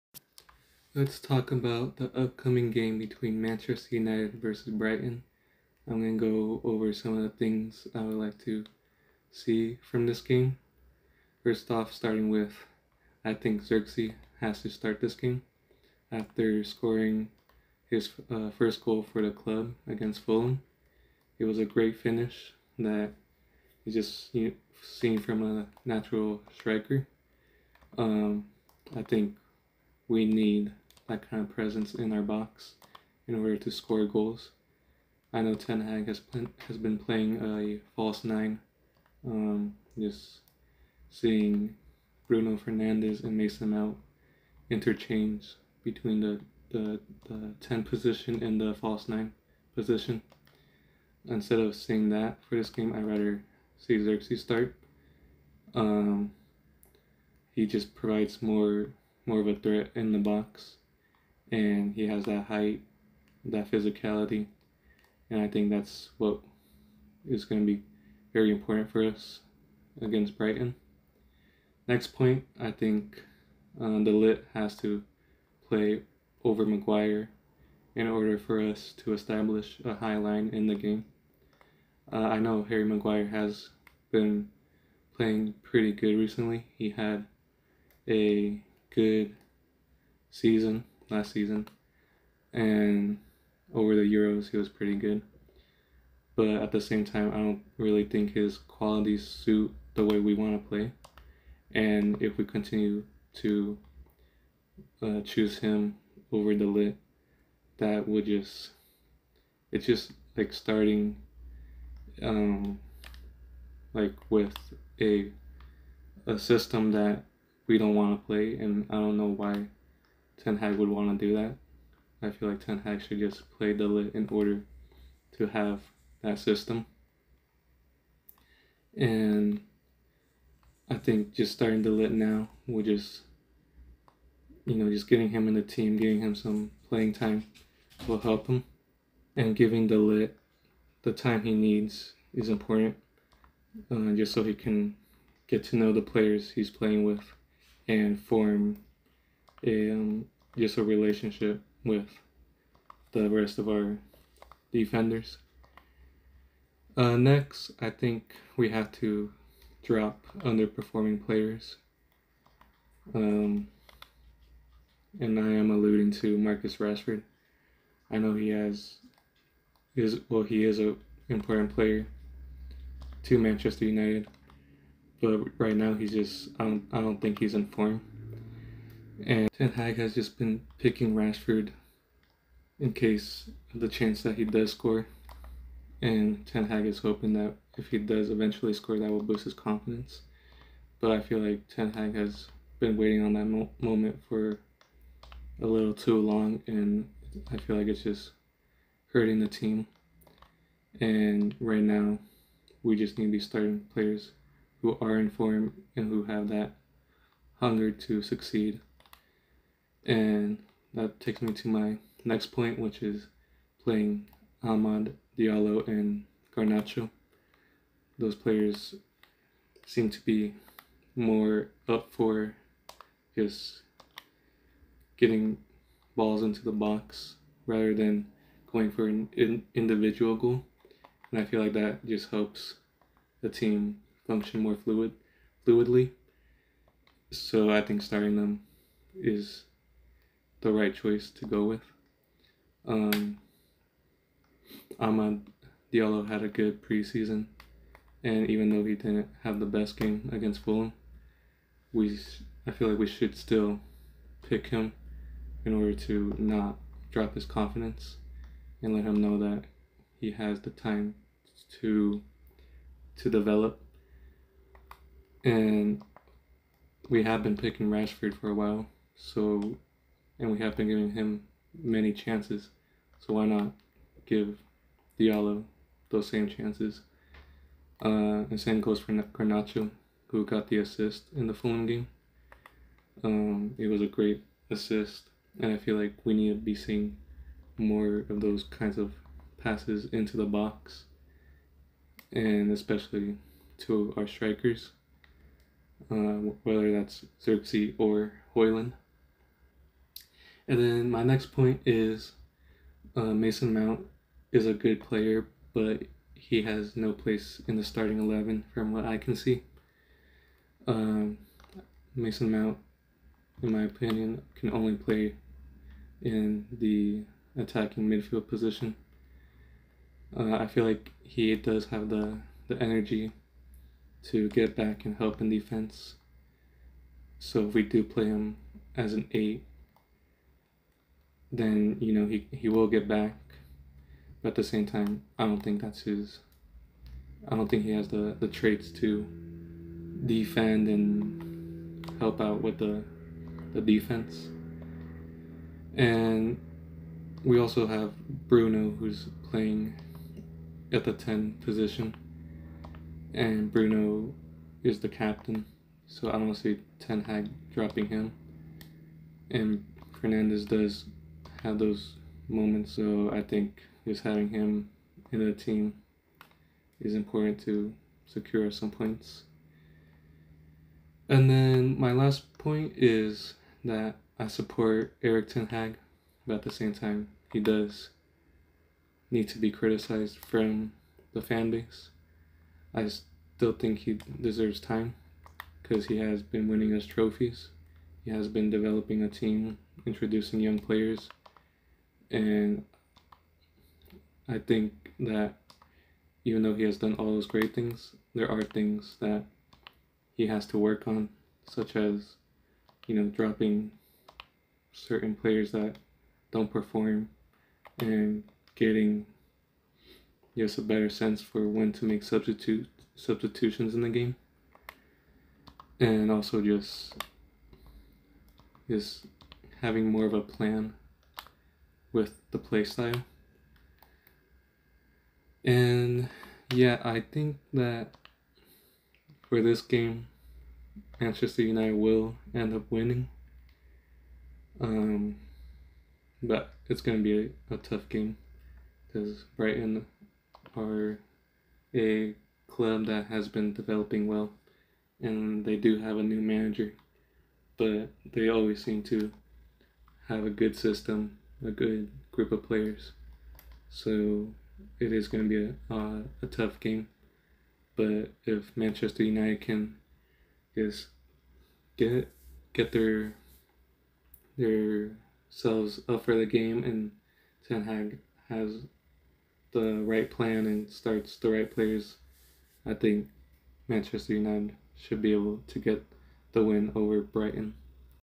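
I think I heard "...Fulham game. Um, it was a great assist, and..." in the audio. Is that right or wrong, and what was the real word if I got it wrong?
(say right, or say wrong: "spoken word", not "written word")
right.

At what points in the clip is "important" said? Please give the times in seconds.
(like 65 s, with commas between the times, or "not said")
68 s, 142 s, 171 s, 367 s.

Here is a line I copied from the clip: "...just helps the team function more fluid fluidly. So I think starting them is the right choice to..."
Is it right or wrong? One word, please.
right.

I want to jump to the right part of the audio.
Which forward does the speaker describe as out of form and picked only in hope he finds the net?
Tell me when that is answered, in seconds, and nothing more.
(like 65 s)
166 s.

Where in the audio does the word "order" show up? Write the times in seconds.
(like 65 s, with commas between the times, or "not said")
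33 s, 78 s, 124 s, 255 s.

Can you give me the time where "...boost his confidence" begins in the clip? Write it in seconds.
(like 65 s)
189 s.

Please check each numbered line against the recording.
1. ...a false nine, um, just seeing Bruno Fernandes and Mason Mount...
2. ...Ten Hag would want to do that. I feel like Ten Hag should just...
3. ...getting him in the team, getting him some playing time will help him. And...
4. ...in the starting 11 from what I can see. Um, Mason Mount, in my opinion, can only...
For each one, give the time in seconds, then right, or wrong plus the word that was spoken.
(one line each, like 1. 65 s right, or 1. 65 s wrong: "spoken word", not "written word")
1. 37 s right
2. 120 s right
3. 135 s right
4. 307 s right.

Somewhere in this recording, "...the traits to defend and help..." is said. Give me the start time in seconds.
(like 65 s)
338 s.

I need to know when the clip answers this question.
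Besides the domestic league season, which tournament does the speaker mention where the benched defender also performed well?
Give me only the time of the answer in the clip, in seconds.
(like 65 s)
94 s.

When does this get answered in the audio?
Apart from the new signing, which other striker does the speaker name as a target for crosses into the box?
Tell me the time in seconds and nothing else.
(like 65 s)
298 s.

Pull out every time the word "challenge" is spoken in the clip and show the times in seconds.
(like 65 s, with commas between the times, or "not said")
not said.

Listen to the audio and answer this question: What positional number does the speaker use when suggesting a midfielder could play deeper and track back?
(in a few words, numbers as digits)
8.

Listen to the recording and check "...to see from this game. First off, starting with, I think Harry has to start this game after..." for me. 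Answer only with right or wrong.
wrong.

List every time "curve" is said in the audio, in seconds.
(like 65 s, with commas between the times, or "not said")
not said.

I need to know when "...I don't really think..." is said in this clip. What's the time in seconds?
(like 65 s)
97 s.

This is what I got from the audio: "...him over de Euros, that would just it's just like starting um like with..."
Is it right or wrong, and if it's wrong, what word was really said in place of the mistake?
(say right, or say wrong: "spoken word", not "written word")
wrong: "Ligt", not "Euros".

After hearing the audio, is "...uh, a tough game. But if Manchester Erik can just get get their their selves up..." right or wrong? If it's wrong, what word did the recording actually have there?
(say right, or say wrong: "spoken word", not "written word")
wrong: "United", not "Erik".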